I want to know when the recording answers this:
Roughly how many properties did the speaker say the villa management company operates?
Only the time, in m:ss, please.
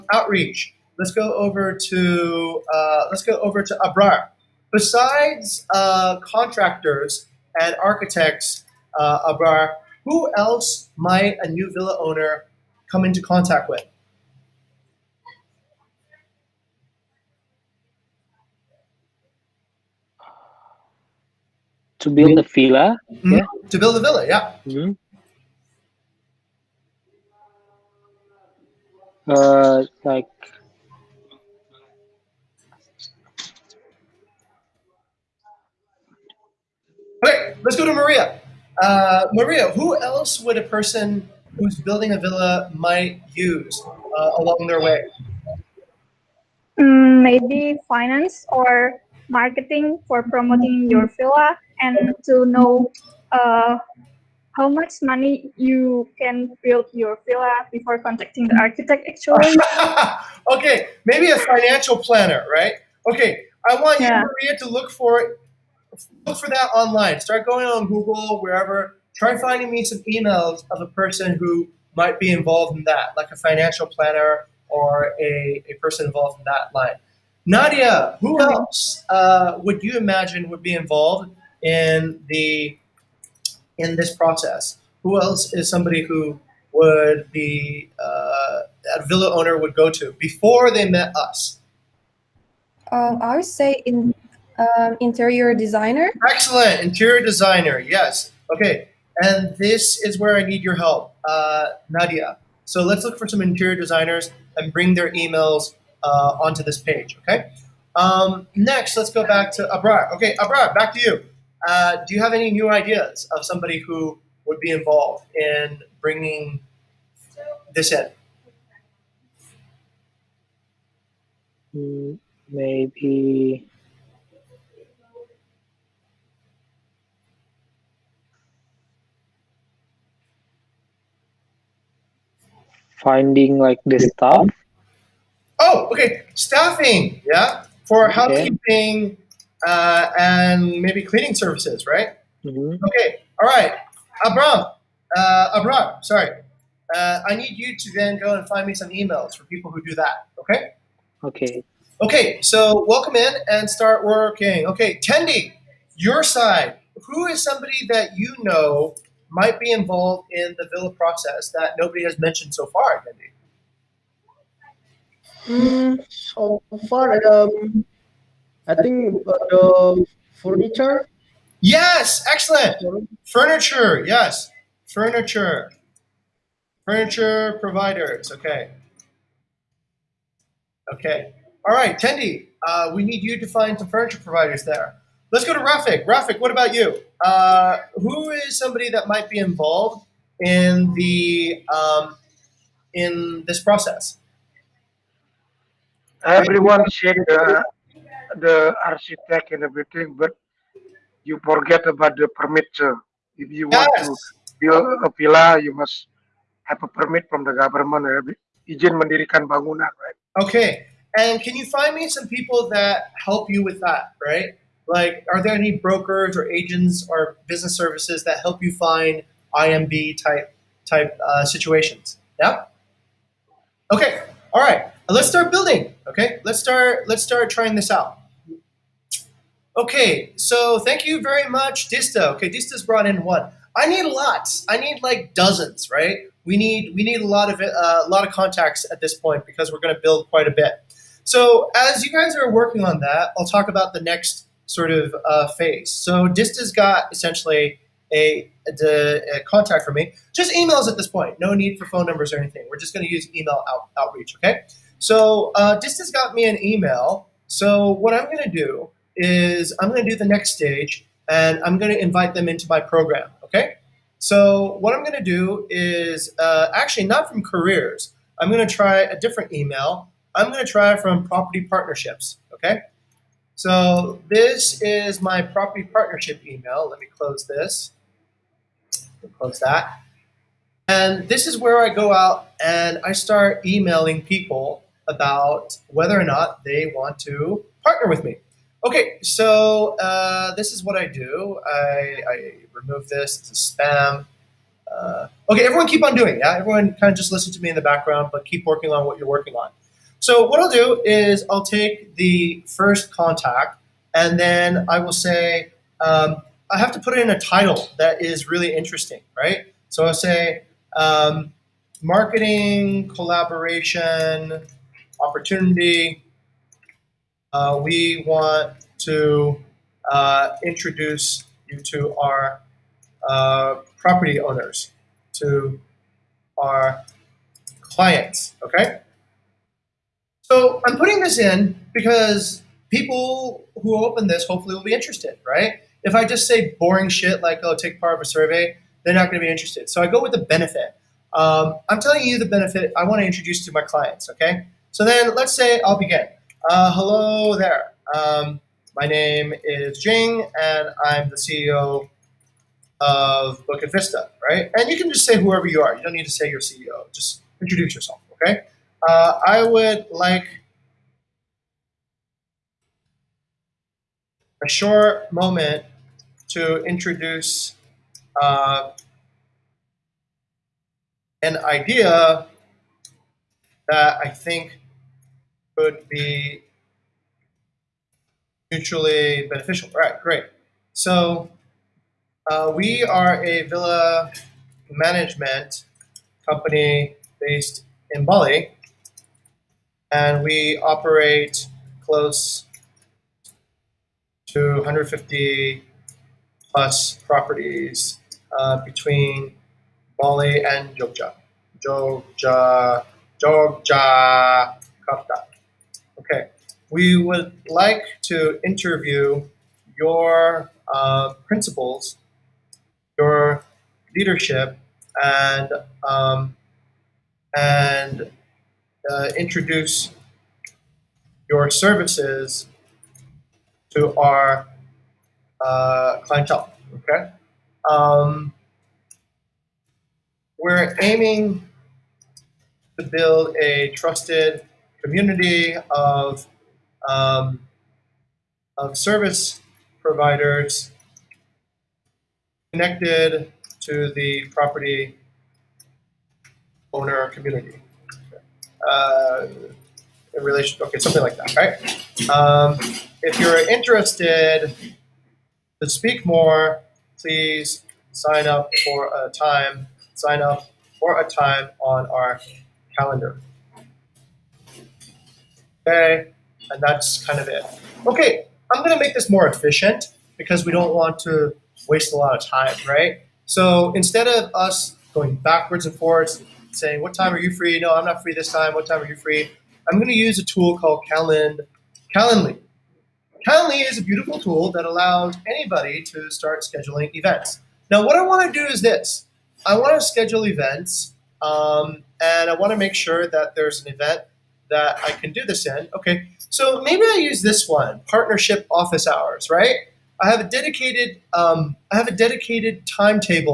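6:34.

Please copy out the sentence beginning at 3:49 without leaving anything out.
Okay, so thank you very much, Dista.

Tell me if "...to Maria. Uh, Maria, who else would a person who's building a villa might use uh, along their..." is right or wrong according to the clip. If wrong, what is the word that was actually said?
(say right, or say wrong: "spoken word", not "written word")
right.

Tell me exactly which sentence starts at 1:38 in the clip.
Okay, and this is where I need your help, uh, Nadia.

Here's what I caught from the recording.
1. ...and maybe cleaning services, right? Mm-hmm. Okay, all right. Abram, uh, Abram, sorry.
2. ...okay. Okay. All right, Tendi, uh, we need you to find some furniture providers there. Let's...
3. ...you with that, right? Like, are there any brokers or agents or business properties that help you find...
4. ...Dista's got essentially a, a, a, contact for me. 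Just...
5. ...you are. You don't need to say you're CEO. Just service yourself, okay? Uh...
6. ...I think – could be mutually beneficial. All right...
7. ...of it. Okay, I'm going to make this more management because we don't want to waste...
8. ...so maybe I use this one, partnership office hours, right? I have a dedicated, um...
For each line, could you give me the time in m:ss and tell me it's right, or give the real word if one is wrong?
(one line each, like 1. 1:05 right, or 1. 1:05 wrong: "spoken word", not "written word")
1. 2:20 right
2. 2:58 right
3. 3:33 wrong: "services", not "properties"
4. 4:06 right
5. 5:55 wrong: "introduce", not "service"
6. 6:14 right
7. 7:47 wrong: "efficient", not "management"
8. 8:16 right.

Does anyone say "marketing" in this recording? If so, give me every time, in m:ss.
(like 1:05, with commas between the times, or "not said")
0:49, 5:12.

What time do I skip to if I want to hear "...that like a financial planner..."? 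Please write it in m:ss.
1:12.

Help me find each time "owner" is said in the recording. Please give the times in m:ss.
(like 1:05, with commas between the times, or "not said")
0:11, 1:29, 5:24, 7:26.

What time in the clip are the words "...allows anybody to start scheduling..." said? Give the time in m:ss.
8:04.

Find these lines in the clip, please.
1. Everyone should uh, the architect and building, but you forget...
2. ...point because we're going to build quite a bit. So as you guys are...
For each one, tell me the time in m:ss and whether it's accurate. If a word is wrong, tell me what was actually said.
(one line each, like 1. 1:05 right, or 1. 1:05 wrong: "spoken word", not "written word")
1. 3:16 wrong: "everything", not "building"
2. 3:59 right.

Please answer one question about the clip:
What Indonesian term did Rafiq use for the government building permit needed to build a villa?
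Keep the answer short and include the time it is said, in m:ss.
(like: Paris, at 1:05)
Ijin mendirikan bangunan, at 3:28.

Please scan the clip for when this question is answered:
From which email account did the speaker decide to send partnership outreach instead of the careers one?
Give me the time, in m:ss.
4:31.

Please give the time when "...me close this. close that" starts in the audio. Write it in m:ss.
4:36.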